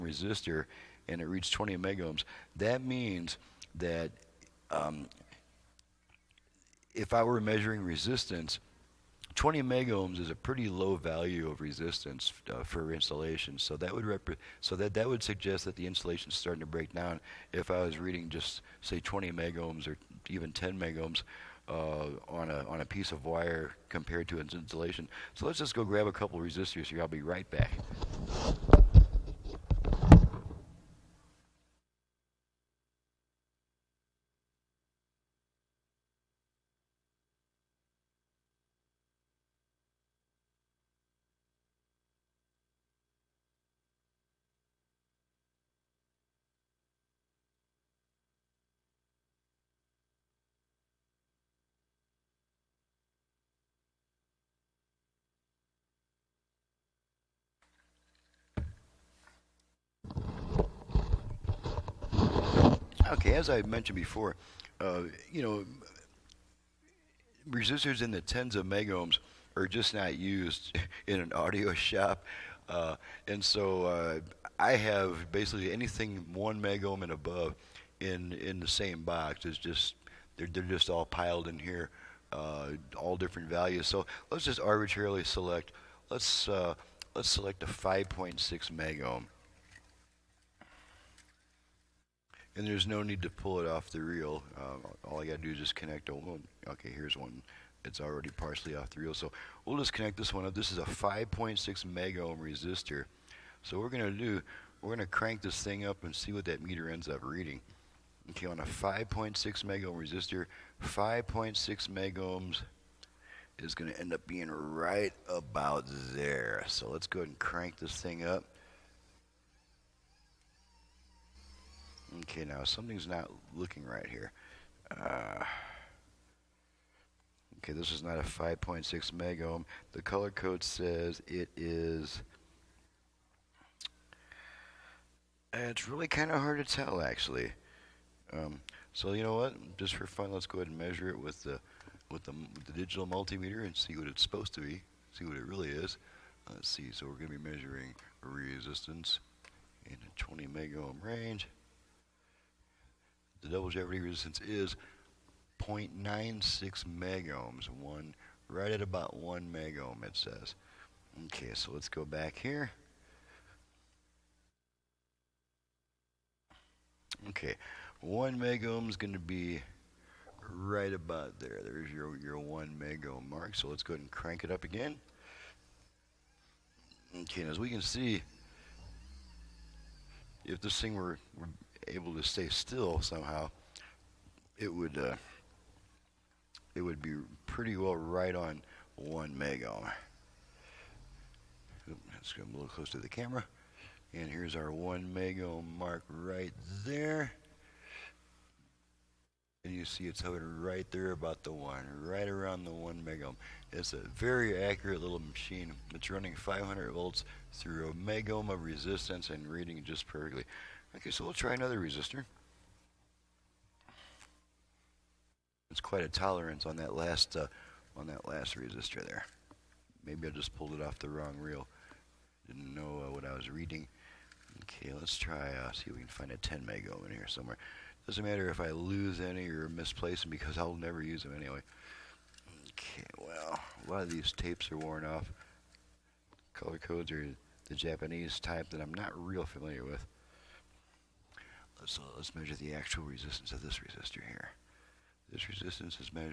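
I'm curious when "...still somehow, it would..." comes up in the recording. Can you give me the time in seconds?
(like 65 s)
182 s.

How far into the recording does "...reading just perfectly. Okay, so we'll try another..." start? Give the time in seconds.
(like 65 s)
209 s.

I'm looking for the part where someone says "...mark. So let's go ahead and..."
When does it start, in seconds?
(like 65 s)
173 s.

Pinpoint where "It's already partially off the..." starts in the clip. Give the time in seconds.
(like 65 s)
97 s.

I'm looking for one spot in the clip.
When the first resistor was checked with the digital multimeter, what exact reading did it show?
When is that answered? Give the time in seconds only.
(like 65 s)
155 s.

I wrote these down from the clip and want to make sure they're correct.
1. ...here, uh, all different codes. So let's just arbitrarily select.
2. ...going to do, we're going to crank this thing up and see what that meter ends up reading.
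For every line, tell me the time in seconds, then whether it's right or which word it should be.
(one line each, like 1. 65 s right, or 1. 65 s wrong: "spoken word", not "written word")
1. 81 s wrong: "values", not "codes"
2. 103 s right.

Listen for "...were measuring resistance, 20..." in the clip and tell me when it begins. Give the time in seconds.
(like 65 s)
7 s.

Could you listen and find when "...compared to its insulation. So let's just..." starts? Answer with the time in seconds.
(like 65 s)
23 s.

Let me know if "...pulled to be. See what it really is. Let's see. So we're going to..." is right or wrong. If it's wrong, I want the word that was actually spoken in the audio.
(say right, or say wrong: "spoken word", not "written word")
wrong: "supposed", not "pulled".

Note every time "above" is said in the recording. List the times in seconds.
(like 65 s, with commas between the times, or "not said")
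77 s.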